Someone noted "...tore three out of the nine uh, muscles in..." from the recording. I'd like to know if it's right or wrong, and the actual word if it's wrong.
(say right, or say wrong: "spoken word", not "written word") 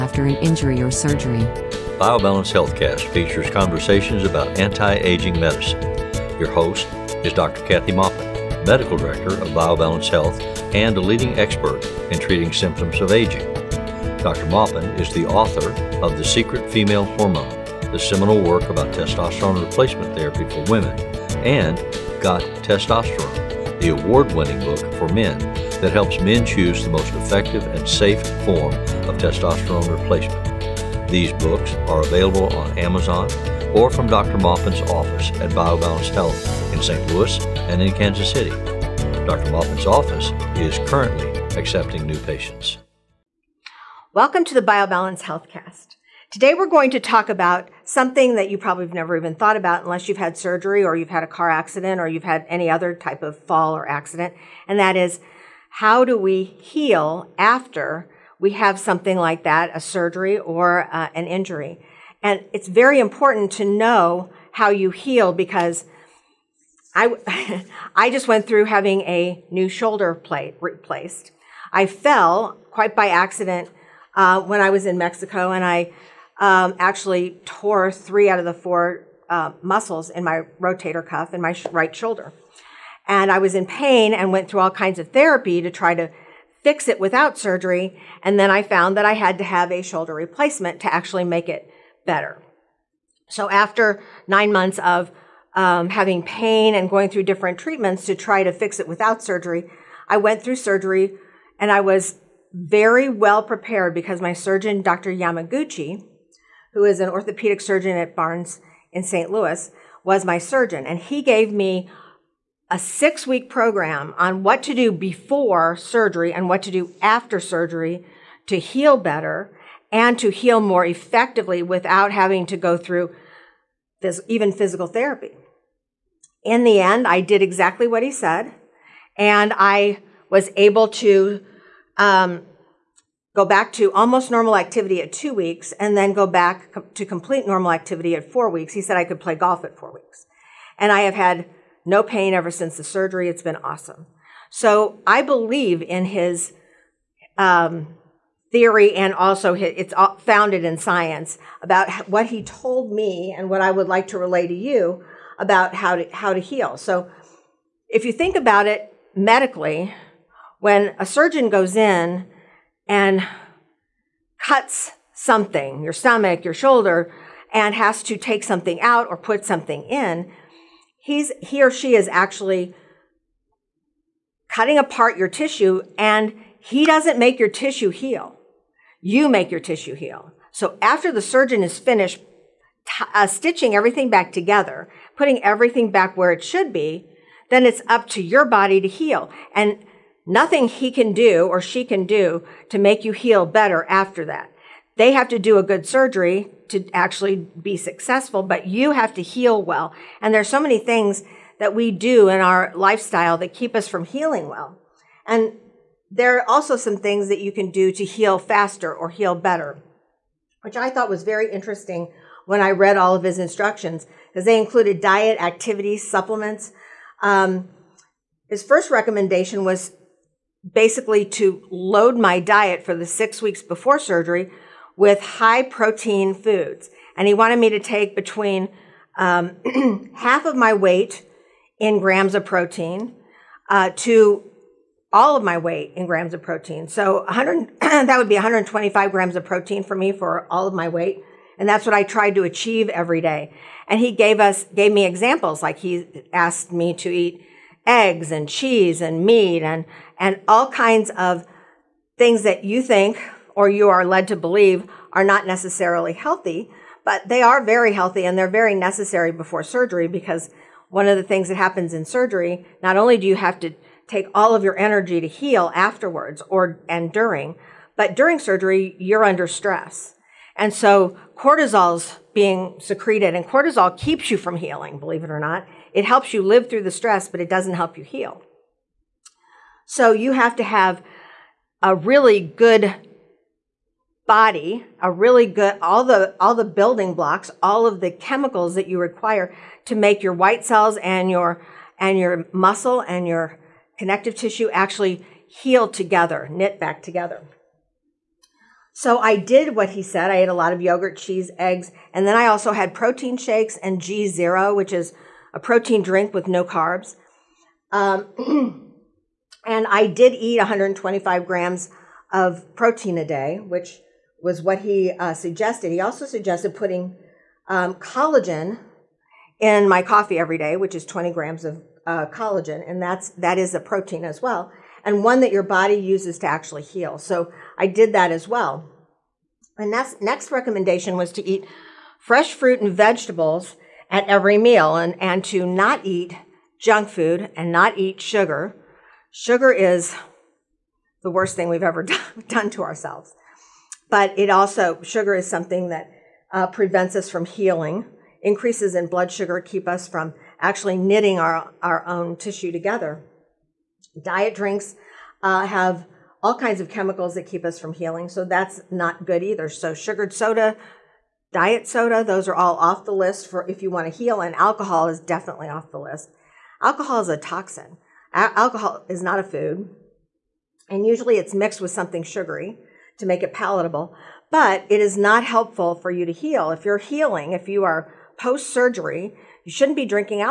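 wrong: "four", not "nine".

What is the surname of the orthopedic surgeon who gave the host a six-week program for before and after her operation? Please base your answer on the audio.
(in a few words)
Yamaguchi.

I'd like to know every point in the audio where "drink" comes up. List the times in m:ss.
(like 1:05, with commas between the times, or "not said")
5:06, 5:54.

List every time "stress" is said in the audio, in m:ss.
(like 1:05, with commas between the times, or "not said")
4:29, 4:36.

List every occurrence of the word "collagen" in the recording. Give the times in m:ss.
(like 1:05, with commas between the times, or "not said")
5:17, 5:22.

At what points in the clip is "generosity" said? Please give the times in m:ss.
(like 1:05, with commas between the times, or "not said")
not said.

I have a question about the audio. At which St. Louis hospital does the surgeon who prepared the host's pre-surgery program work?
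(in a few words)
Barnes.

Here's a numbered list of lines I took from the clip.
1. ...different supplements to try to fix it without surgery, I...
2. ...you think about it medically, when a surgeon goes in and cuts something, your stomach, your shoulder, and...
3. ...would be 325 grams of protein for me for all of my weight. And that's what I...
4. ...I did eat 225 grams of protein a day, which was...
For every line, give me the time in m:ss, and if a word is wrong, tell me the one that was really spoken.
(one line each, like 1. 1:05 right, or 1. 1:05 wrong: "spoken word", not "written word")
1. 1:37 wrong: "treatments", not "supplements"
2. 2:38 right
3. 3:58 wrong: "125", not "325"
4. 5:09 wrong: "125", not "225".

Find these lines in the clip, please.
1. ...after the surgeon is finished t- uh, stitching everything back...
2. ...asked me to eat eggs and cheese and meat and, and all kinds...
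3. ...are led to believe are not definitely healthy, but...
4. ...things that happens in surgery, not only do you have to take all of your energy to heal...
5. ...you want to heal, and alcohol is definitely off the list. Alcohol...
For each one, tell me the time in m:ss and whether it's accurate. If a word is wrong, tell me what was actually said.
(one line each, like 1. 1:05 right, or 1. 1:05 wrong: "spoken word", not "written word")
1. 3:00 right
2. 4:06 right
3. 4:13 wrong: "necessarily", not "definitely"
4. 4:21 right
5. 6:03 right.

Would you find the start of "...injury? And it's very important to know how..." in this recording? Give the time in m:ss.
1:01.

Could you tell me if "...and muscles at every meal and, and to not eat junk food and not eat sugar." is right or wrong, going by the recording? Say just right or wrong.
wrong.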